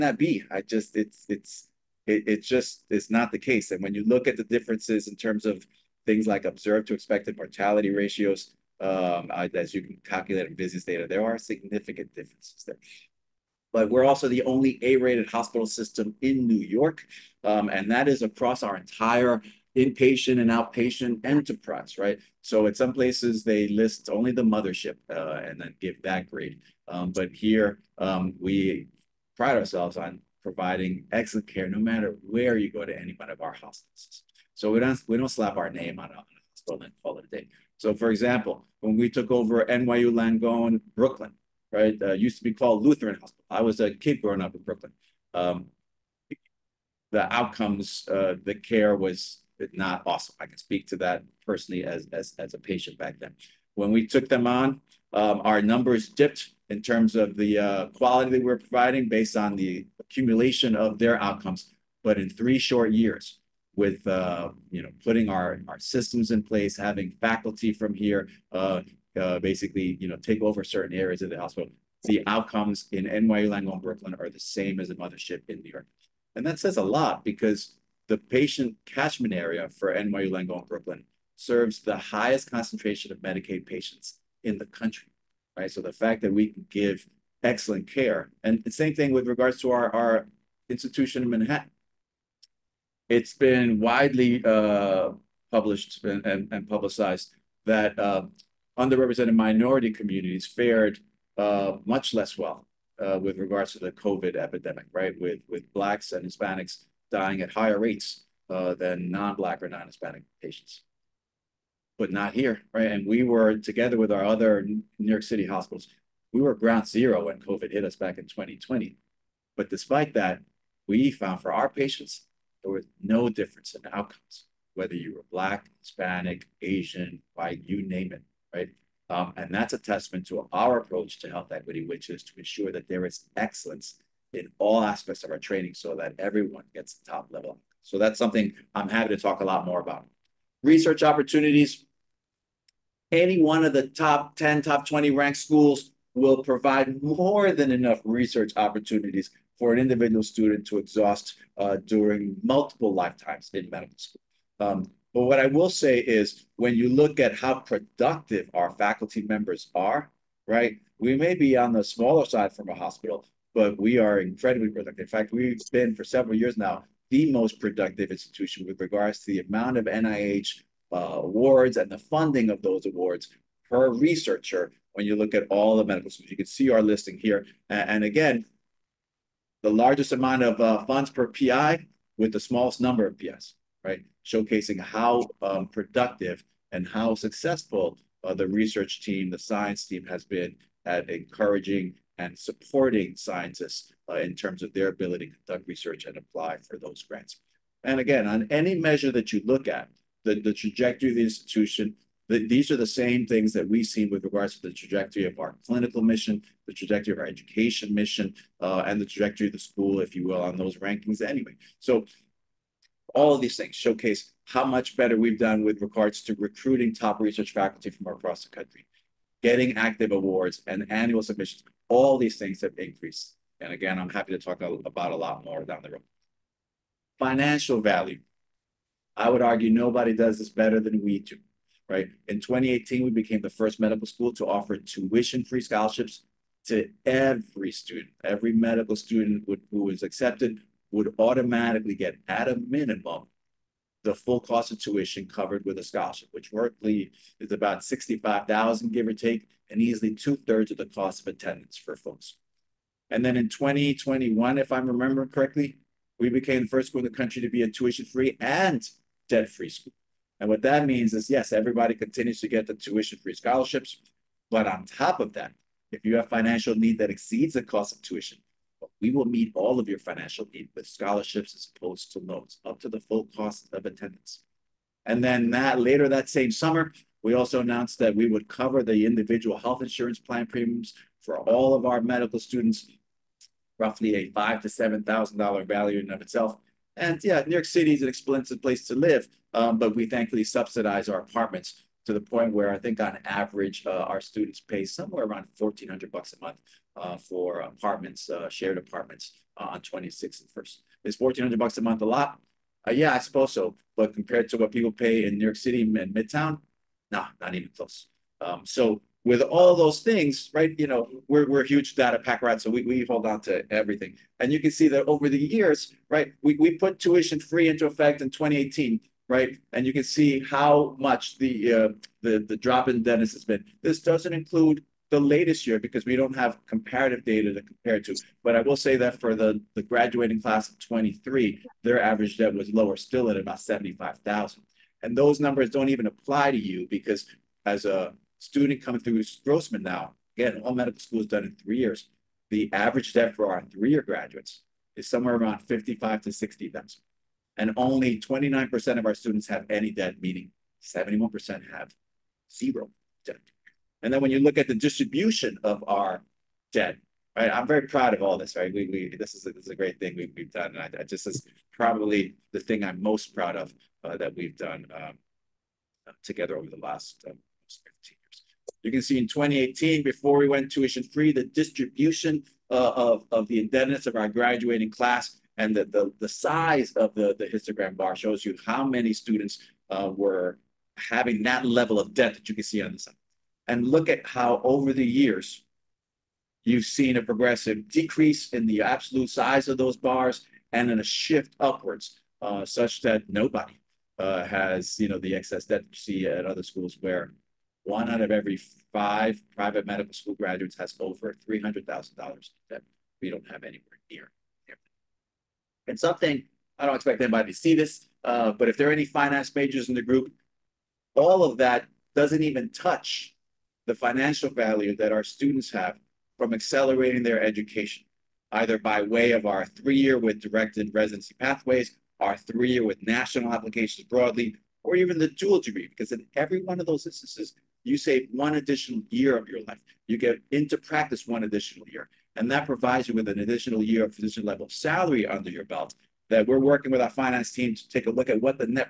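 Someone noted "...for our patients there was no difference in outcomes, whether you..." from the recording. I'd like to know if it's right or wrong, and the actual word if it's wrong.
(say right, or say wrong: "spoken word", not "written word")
right.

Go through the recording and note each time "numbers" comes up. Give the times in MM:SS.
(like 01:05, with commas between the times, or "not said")
00:55, 03:02, 05:35.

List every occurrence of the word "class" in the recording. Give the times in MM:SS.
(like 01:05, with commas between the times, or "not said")
05:30, 06:14.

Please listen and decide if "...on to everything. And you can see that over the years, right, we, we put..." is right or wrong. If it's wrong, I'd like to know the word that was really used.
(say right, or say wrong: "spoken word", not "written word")
right.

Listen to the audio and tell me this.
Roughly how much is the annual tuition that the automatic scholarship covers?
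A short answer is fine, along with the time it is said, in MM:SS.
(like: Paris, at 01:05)
65,000, at 04:07.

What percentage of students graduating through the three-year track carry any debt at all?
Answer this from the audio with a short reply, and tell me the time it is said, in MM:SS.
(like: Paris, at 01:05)
29%, at 05:48.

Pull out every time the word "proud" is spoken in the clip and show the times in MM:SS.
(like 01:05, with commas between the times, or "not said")
05:57, 06:03.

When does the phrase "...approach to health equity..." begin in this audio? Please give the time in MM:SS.
02:10.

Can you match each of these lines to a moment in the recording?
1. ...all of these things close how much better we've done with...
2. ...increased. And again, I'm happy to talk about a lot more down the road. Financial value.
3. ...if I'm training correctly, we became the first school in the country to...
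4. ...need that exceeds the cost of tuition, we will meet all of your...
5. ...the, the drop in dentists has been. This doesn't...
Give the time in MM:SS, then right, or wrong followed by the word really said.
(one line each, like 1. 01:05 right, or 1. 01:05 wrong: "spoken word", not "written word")
1. 03:33 wrong: "showcase", not "close"
2. 03:42 right
3. 04:14 wrong: "remembering", not "training"
4. 04:26 right
5. 05:22 right.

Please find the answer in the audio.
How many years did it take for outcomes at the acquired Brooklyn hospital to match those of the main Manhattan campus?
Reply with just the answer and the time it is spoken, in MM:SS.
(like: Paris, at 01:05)
3, at 01:02.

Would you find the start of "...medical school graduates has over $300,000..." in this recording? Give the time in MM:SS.
06:39.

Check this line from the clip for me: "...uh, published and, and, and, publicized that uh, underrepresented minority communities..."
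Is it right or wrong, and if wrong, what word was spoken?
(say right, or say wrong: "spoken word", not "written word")
right.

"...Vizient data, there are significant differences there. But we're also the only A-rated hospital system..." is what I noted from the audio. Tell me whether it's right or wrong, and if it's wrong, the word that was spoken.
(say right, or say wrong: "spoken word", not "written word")
right.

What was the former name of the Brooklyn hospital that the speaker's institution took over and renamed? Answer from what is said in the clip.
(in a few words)
Lutheran Hospital.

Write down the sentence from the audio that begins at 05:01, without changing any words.
Is 1400 bucks a month a lot?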